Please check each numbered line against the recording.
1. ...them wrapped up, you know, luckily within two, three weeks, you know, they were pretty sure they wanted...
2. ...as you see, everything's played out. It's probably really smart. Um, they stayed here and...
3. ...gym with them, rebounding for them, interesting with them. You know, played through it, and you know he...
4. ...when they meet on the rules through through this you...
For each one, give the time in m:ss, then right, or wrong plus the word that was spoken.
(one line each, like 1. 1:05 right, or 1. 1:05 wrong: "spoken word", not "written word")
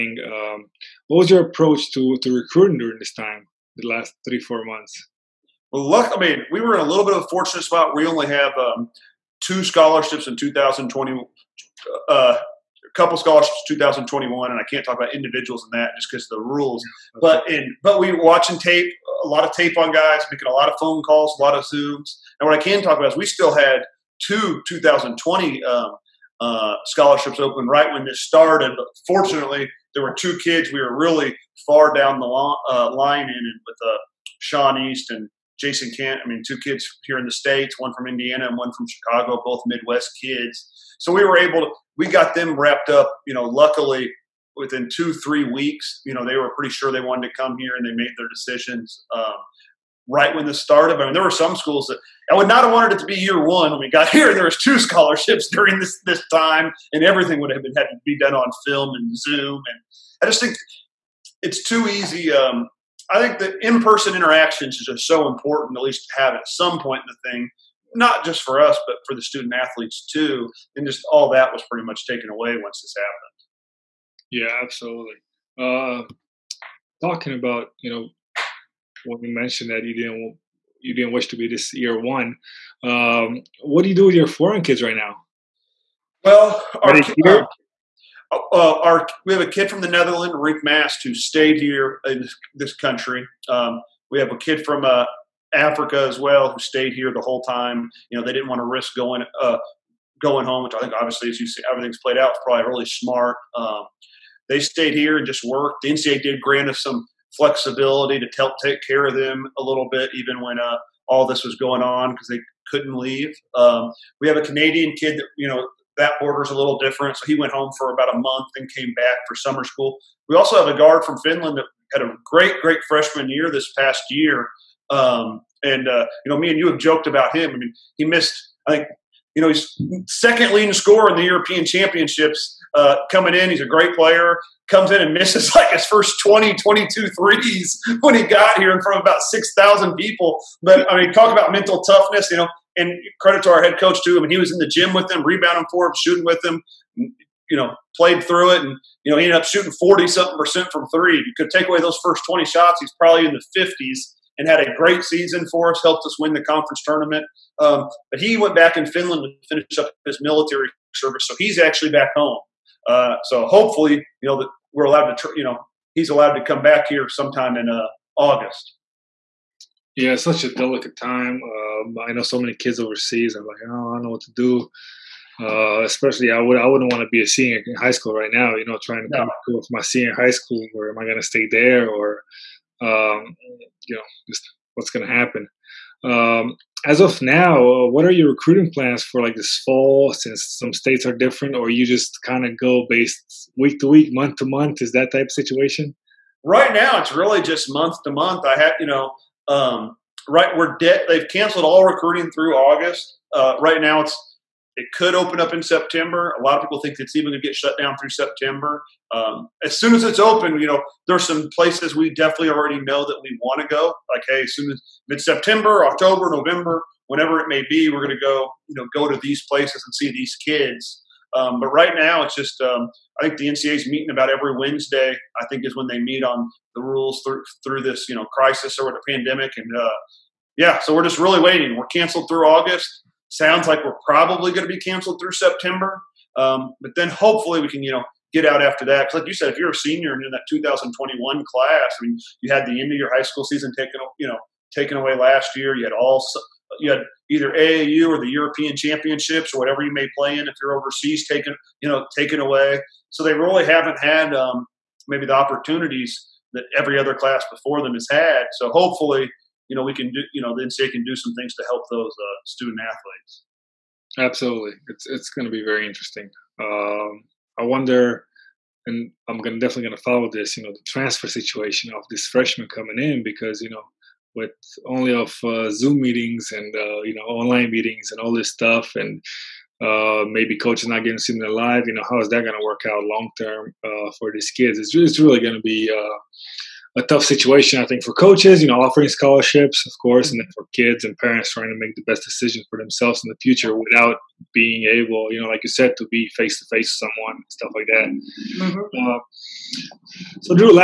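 1. 0:42 right
2. 1:41 right
3. 2:24 wrong: "shooting", not "interesting"
4. 3:45 right.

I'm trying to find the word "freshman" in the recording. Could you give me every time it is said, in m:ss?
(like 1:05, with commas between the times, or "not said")
2:02, 4:32.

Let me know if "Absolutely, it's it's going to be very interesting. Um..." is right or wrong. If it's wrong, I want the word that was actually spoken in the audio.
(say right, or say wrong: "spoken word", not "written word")
right.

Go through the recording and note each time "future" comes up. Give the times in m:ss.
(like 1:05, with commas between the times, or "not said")
4:53.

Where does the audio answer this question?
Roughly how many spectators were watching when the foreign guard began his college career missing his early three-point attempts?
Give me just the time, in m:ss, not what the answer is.
2:19.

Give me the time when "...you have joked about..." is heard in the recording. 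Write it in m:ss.
2:06.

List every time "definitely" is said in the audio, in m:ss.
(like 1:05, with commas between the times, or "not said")
3:32, 4:29.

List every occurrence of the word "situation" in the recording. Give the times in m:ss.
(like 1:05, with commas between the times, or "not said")
3:15, 4:31, 4:47.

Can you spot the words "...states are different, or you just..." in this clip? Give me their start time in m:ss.
3:10.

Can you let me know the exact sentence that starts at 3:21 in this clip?
They've canceled all recruiting through August.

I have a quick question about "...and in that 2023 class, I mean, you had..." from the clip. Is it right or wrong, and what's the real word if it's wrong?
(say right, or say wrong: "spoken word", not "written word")
wrong: "2021", not "2023".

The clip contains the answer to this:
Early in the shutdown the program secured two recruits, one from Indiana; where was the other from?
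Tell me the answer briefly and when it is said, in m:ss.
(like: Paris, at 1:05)
Chicago, at 0:38.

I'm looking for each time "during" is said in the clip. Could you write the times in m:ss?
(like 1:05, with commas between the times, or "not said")
0:02, 0:55.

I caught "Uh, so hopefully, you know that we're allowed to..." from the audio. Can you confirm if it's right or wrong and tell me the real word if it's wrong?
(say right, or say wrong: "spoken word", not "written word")
right.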